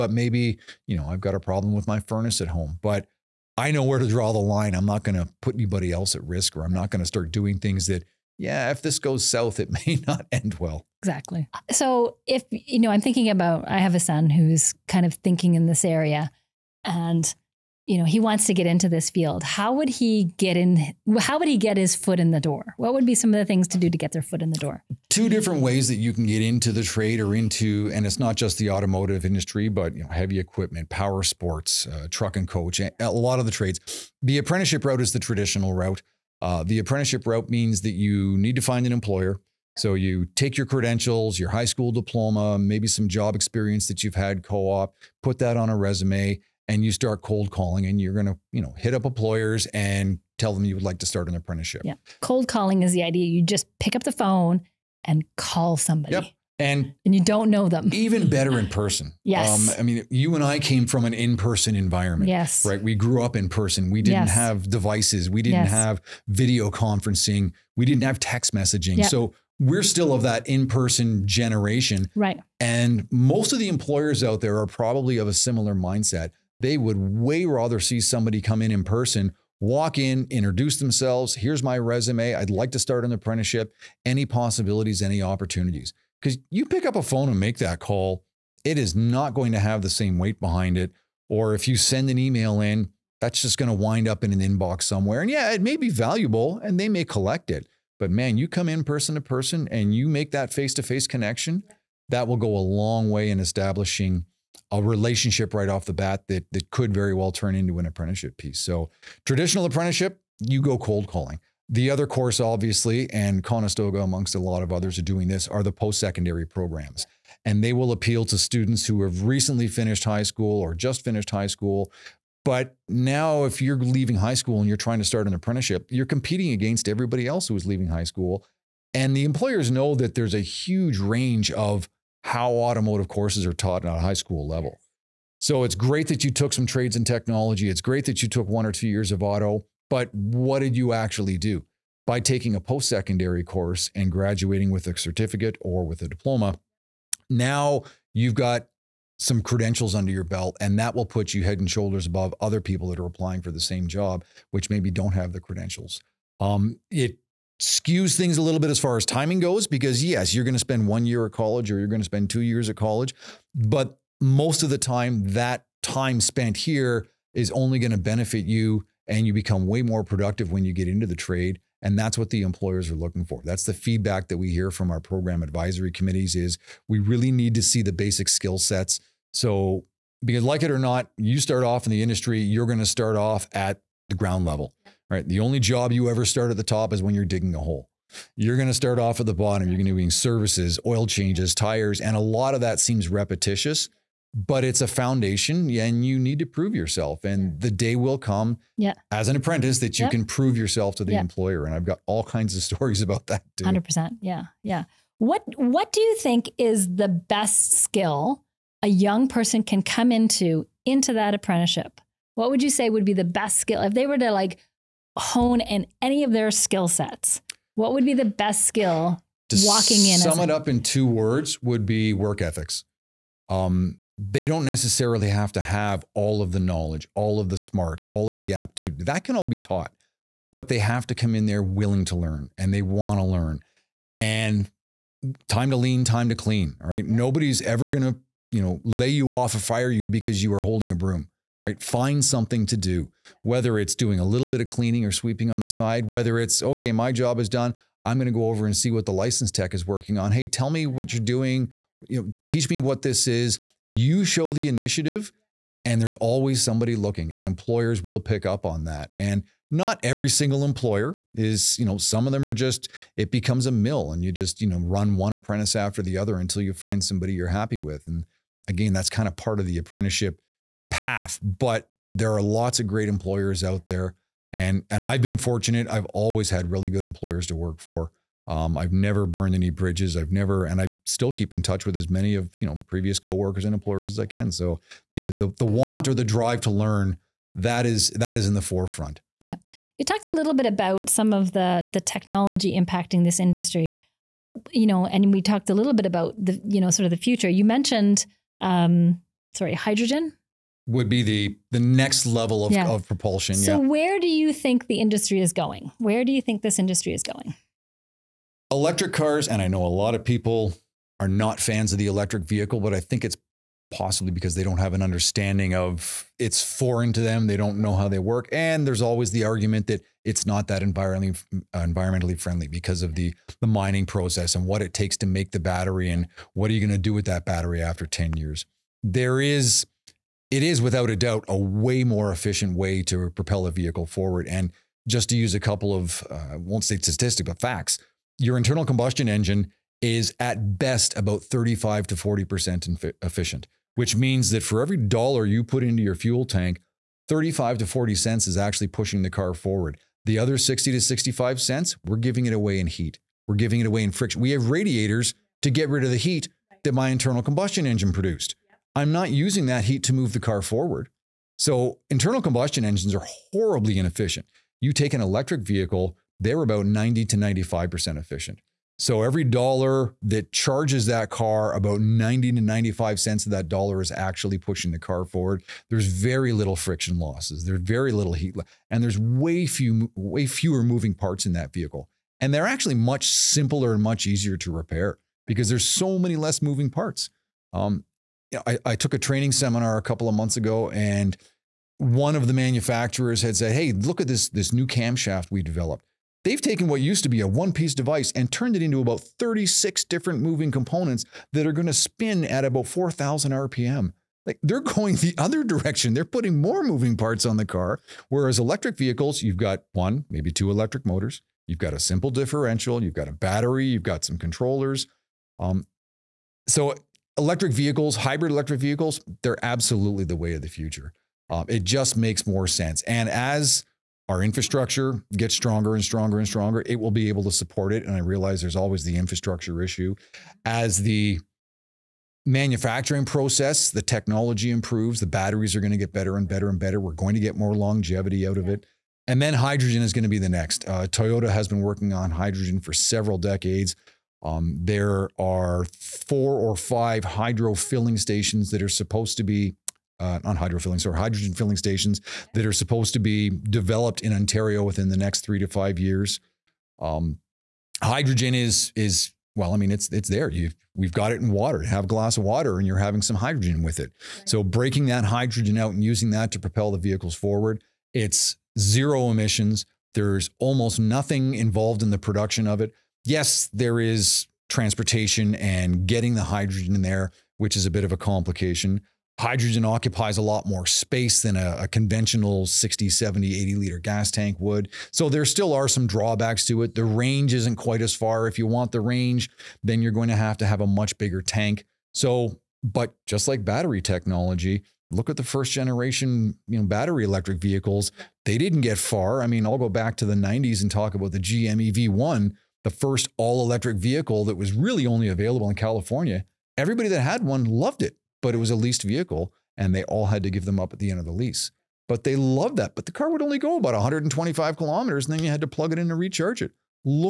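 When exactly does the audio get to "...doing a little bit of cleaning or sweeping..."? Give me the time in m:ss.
4:03.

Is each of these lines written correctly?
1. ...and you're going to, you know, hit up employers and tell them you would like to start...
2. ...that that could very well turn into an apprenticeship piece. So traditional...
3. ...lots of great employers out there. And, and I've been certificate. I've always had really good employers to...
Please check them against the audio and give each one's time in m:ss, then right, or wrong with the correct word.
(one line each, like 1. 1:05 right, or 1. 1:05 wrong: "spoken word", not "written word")
1. 0:47 right
2. 1:46 right
3. 4:32 wrong: "fortunate", not "certificate".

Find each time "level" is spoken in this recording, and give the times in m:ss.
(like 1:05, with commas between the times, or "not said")
2:14, 3:04, 5:02.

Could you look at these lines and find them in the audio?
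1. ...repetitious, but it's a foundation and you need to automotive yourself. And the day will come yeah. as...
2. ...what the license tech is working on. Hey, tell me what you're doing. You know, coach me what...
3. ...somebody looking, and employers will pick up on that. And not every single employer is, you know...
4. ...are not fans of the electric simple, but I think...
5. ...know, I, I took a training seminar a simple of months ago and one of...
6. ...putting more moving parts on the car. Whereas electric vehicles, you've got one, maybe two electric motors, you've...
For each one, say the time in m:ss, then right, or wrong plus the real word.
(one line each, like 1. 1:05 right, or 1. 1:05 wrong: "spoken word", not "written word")
1. 3:13 wrong: "prove", not "automotive"
2. 4:08 wrong: "teach", not "coach"
3. 4:16 right
4. 5:11 wrong: "vehicle", not "simple"
5. 6:28 wrong: "couple", not "simple"
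6. 6:46 right.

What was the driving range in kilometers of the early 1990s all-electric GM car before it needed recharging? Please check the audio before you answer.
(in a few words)
125 kilometers.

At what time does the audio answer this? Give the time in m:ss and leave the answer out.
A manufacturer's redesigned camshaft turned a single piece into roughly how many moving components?
6:39.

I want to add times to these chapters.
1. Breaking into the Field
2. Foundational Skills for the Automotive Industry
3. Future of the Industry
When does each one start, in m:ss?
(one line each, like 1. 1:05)
1. 0:11
2. 3:26
3. 5:01.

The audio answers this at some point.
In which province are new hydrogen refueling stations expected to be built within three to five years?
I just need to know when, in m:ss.
7:34.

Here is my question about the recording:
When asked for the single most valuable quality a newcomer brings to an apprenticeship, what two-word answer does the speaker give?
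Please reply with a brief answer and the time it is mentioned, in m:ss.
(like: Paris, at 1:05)
Work ethics, at 3:42.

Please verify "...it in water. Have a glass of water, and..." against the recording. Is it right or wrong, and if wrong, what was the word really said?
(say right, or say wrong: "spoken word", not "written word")
right.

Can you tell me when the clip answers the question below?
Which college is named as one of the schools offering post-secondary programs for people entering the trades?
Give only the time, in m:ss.
1:53.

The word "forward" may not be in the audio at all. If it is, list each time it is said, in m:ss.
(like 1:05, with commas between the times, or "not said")
5:34, 5:49, 6:00, 6:15, 7:47.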